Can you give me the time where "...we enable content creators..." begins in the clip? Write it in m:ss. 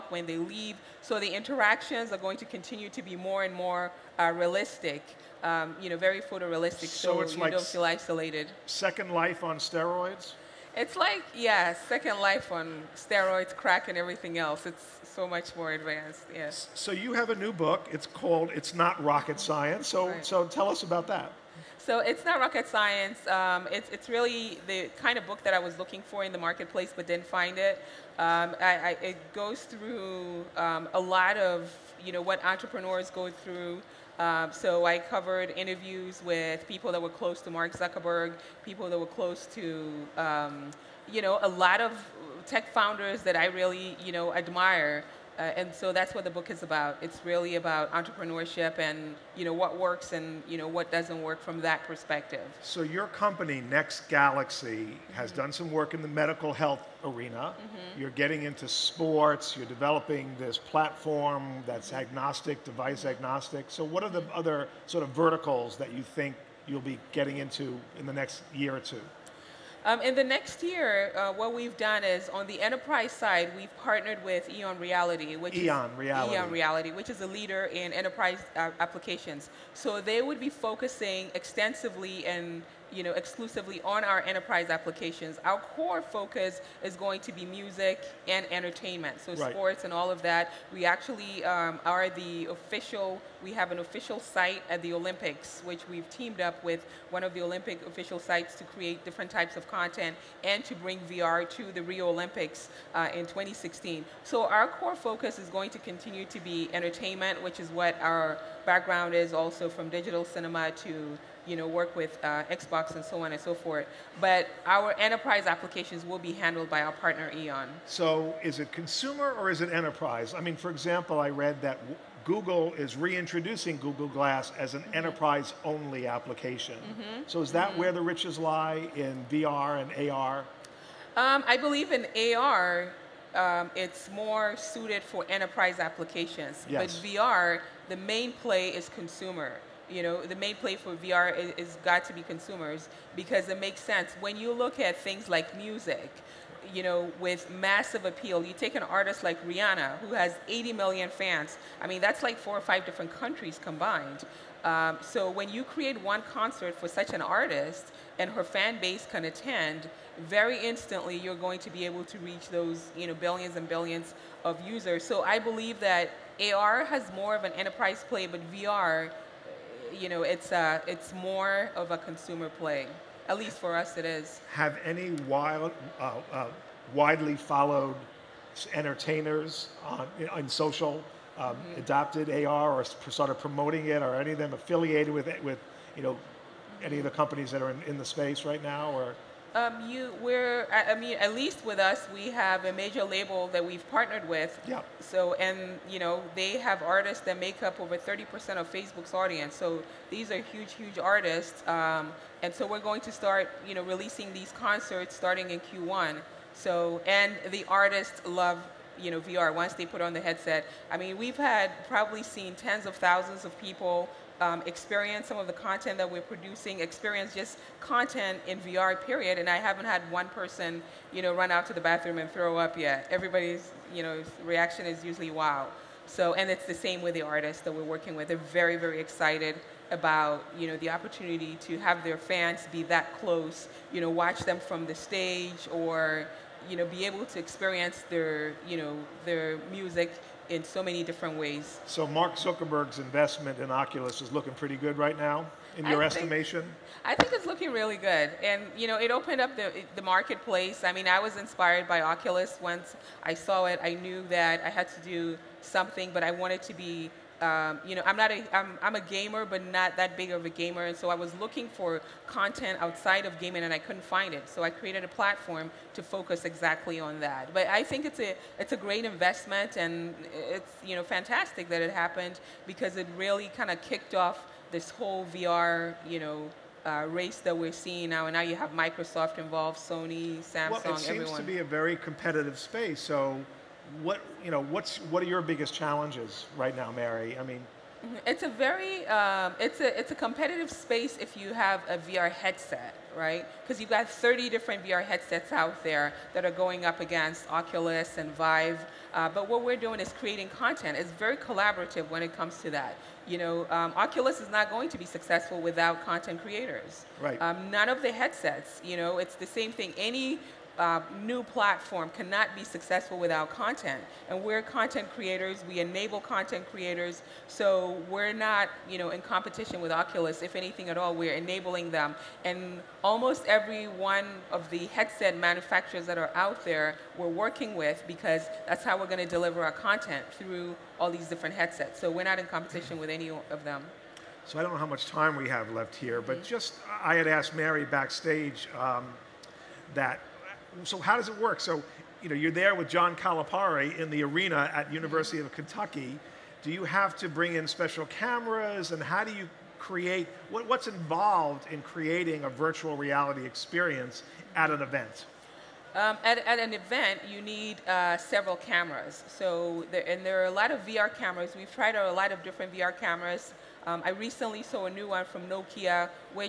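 5:15.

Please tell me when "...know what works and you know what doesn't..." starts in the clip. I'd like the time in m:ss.
0:49.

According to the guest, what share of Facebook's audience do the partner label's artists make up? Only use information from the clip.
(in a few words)
over 30%.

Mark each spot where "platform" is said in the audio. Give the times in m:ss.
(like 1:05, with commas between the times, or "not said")
1:00, 4:25, 5:11.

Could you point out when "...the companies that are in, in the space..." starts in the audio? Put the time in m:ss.
3:07.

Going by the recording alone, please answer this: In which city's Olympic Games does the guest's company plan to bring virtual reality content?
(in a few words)
Rio.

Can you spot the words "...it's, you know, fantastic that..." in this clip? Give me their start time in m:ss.
4:30.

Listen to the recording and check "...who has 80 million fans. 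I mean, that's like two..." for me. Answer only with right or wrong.
wrong.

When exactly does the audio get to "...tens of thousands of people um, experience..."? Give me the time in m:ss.
3:32.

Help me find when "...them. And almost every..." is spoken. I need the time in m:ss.
5:21.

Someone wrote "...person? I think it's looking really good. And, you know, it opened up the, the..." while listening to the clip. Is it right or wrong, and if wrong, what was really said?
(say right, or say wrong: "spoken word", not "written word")
wrong: "estimation", not "person".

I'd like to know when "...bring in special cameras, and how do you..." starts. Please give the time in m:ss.
5:47.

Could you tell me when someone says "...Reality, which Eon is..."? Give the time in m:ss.
1:14.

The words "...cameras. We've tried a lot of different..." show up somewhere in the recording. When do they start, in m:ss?
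6:01.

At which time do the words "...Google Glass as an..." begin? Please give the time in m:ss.
2:03.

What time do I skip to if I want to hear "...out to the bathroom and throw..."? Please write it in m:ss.
3:41.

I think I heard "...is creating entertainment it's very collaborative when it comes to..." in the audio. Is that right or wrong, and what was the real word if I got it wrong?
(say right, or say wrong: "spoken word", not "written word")
wrong: "content", not "entertainment".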